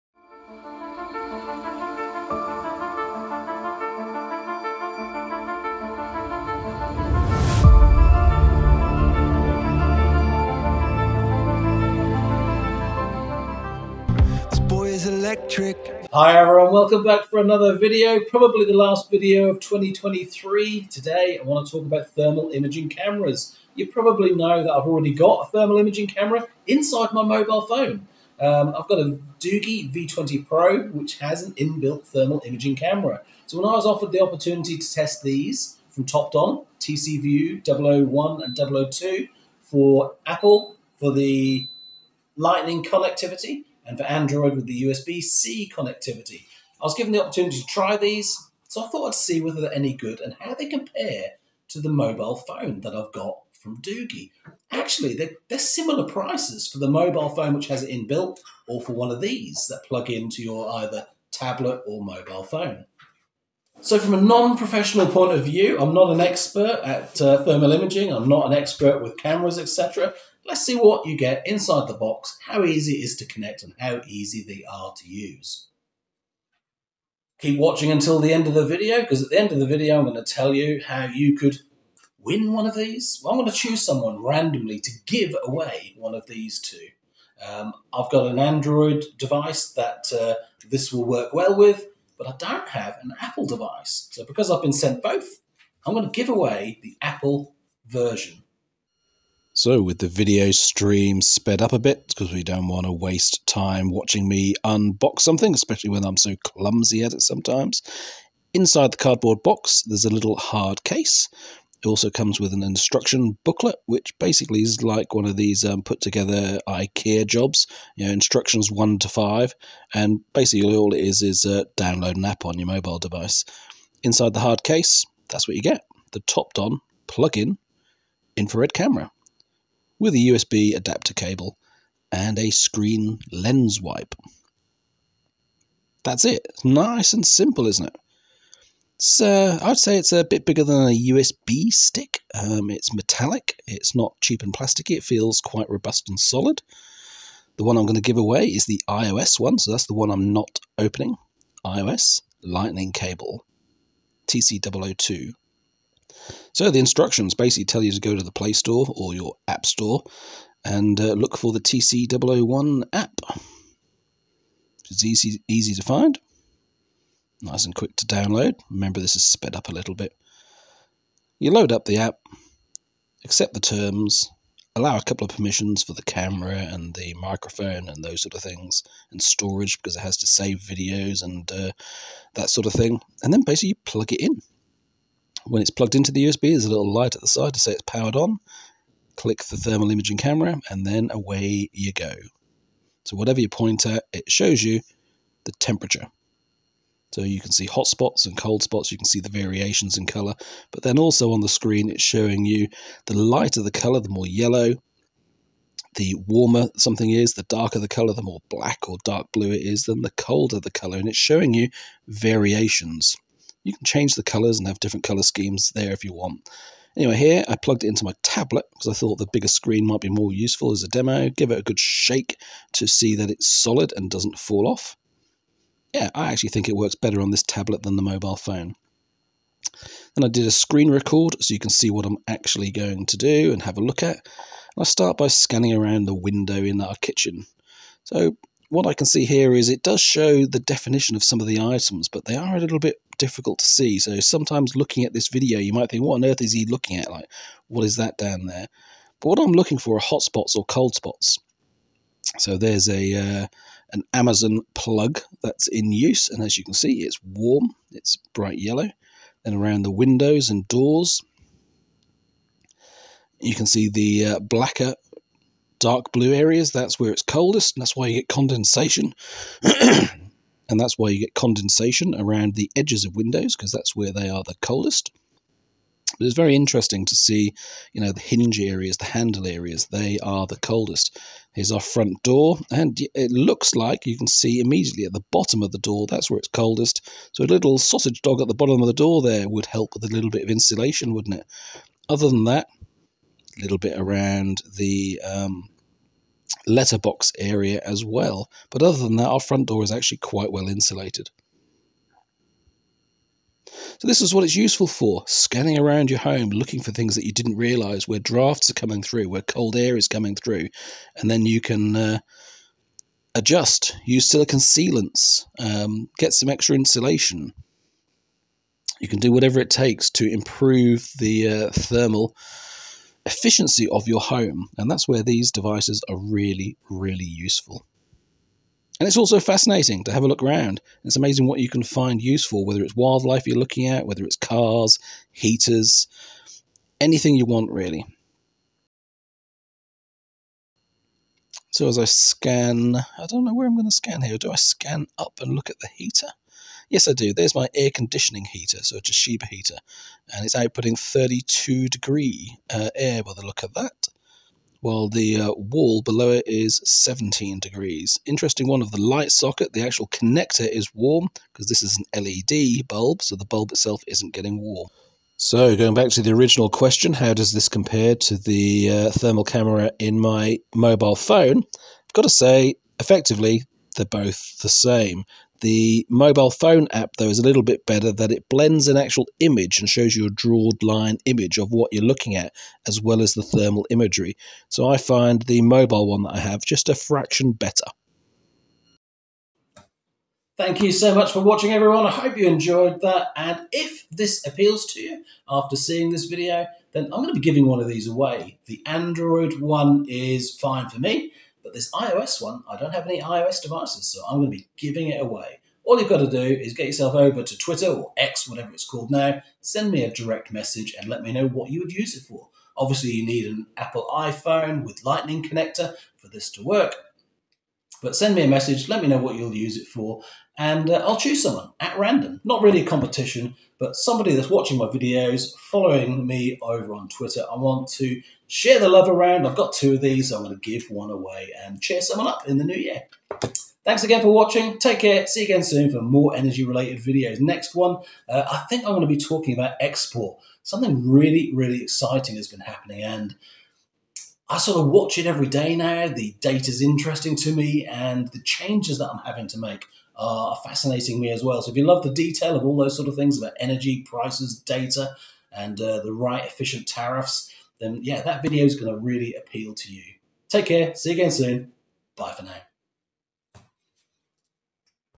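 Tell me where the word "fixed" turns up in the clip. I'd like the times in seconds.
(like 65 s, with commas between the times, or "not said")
not said.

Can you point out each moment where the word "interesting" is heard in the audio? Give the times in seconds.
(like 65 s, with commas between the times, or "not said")
276 s, 358 s, 446 s.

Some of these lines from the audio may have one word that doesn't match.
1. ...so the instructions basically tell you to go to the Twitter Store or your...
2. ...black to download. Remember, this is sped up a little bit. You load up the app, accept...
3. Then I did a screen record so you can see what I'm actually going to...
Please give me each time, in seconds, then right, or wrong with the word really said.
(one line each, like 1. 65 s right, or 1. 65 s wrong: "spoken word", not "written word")
1. 156 s wrong: "Play", not "Twitter"
2. 167 s wrong: "quick", not "black"
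3. 230 s right.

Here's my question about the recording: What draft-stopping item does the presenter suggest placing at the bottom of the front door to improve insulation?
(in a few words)
sausage dog.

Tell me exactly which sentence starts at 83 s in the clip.
Well, I'm going to choose someone randomly to give away one of these two.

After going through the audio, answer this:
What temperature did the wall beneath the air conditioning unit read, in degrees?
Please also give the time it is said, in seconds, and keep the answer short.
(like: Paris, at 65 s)
17, at 356 s.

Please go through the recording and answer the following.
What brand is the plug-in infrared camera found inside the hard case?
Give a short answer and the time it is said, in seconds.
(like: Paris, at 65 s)
TOPDON, at 126 s.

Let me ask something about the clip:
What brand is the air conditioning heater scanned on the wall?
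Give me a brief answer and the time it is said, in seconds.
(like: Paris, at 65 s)
Toshiba, at 349 s.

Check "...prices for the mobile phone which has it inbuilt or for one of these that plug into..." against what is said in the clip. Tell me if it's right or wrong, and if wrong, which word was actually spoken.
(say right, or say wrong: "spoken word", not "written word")
right.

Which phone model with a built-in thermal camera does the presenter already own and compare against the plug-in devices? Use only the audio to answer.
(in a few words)
Doogee V20 Pro.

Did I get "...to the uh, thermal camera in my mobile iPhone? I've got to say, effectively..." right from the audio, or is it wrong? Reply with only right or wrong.
wrong.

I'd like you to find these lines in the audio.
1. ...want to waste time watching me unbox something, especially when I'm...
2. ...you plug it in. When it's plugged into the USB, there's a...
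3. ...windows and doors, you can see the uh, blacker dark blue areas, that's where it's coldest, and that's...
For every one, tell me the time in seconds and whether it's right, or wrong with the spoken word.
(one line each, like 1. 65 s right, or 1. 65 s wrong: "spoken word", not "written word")
1. 102 s right
2. 183 s right
3. 259 s right.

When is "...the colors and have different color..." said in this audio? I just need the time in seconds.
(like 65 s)
214 s.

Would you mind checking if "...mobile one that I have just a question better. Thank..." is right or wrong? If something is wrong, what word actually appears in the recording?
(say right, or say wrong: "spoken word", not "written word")
wrong: "fraction", not "question".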